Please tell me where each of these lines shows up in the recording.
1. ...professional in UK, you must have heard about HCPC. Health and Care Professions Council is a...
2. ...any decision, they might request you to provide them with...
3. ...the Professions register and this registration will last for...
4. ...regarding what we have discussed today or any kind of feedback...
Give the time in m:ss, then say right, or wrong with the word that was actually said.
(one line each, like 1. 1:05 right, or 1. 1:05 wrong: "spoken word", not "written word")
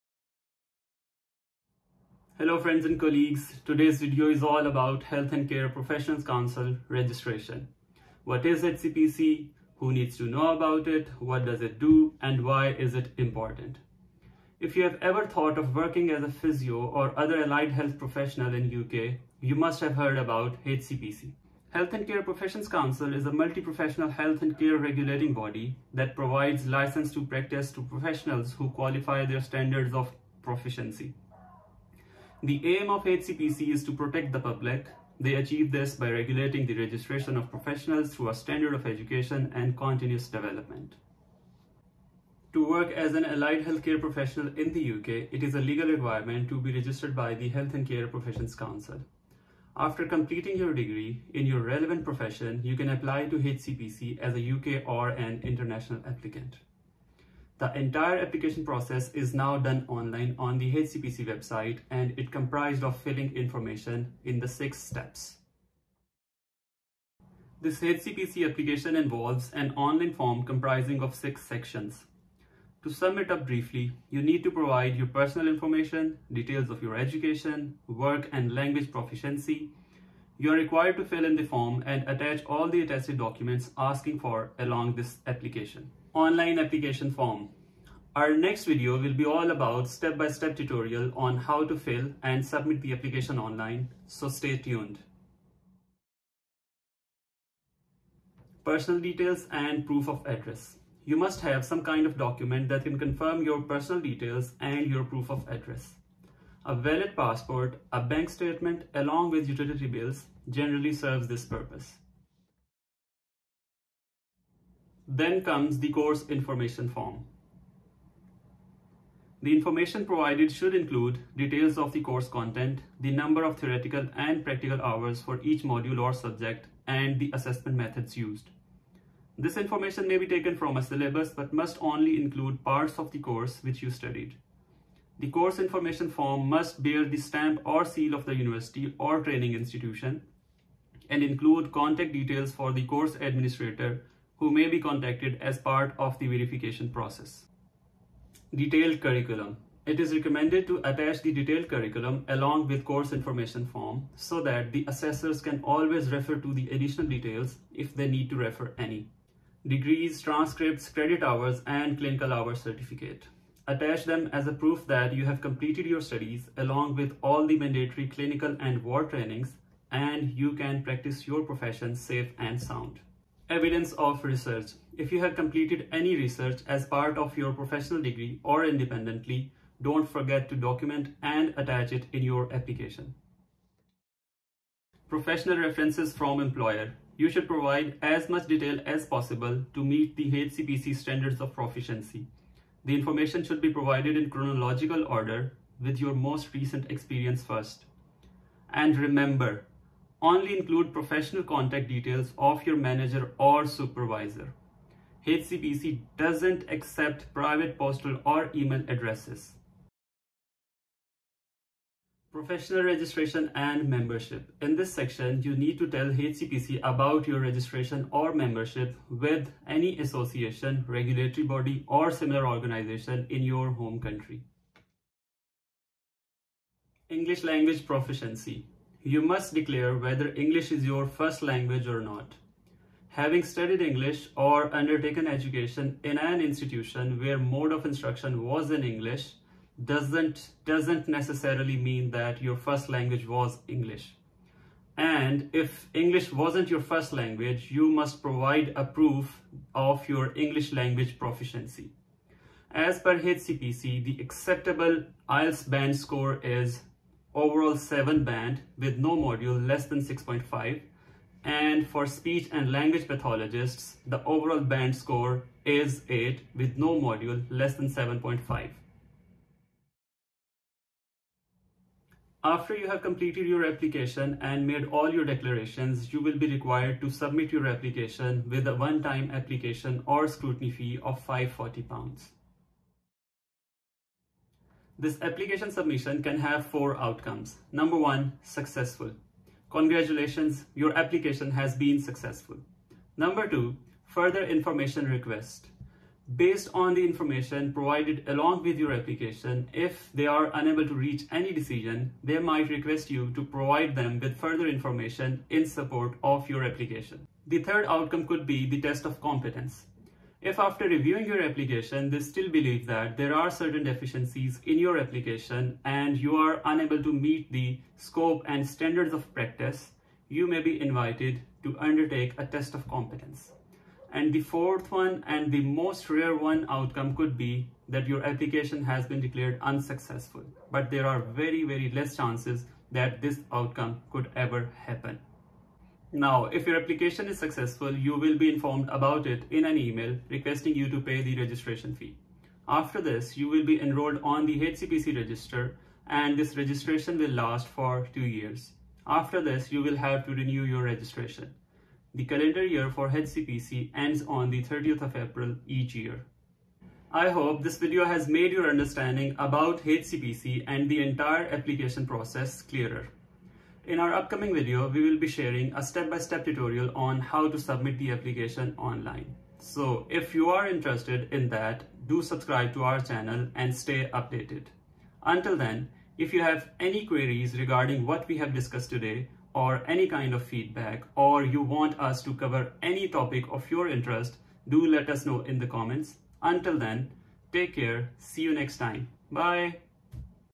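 1. 0:17 right
2. 5:01 right
3. 5:44 wrong: "HCPC", not "Professions"
4. 6:17 right.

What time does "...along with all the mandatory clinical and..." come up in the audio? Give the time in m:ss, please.
2:46.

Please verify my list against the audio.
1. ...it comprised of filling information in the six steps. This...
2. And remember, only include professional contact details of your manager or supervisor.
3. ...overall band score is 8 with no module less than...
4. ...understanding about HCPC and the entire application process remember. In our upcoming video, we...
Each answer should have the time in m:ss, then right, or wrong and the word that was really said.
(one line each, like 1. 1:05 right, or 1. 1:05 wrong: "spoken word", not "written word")
1. 1:02 right
2. 3:18 right
3. 4:24 right
4. 5:58 wrong: "clearer", not "remember".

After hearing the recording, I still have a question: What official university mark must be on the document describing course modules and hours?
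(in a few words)
stamp or seal.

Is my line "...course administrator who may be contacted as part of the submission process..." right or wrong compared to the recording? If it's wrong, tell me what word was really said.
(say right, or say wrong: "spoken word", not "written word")
wrong: "verification", not "submission".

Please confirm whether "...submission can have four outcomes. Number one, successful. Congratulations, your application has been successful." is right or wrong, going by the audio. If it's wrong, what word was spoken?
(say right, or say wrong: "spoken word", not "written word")
right.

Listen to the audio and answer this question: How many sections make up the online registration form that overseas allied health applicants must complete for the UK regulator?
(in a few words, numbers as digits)
6.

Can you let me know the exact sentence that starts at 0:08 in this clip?
What is HCPC, who needs to know about it, what does it do, and why is it important?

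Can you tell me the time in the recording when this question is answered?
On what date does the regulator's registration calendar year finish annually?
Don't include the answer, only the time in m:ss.
5:54.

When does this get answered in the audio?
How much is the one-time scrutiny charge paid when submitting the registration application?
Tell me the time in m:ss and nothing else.
4:41.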